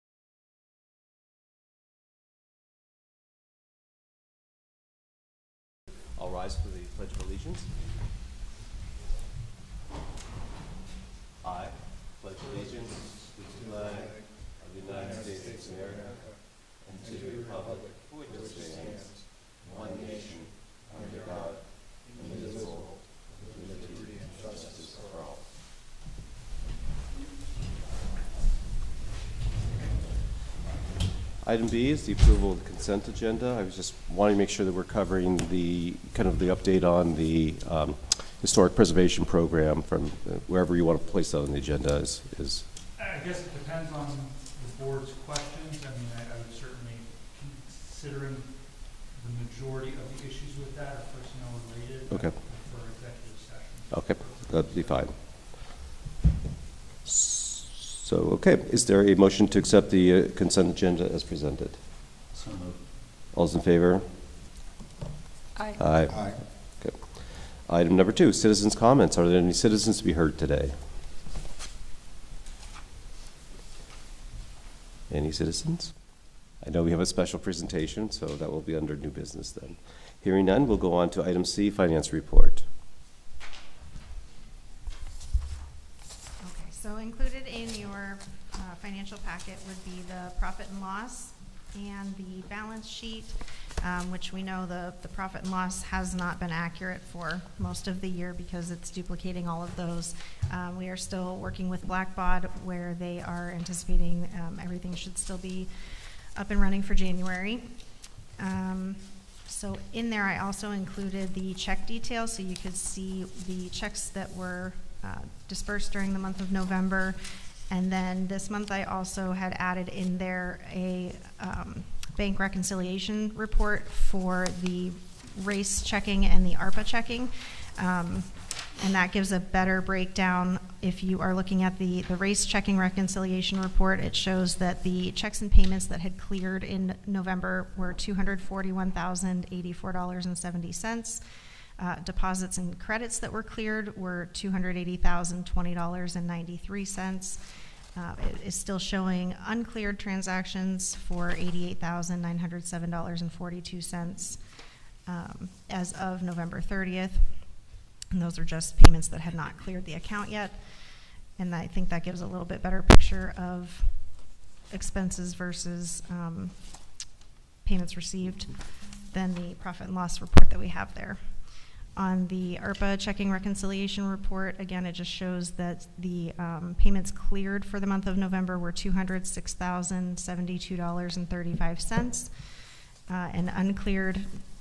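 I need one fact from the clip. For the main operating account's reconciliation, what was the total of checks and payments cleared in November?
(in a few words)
$241,084.70.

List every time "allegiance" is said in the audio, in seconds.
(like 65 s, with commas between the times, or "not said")
7 s, 12 s.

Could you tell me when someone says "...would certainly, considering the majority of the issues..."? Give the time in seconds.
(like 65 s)
46 s.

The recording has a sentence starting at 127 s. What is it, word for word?
Um, and that gives a better breakdown.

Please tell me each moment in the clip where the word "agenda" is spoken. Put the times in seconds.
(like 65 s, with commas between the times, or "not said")
33 s, 41 s, 60 s.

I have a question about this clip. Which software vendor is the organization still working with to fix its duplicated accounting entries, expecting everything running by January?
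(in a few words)
Blackbaud.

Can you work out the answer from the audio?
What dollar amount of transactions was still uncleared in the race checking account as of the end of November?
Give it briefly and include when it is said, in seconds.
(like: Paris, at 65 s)
$88,907.42, at 151 s.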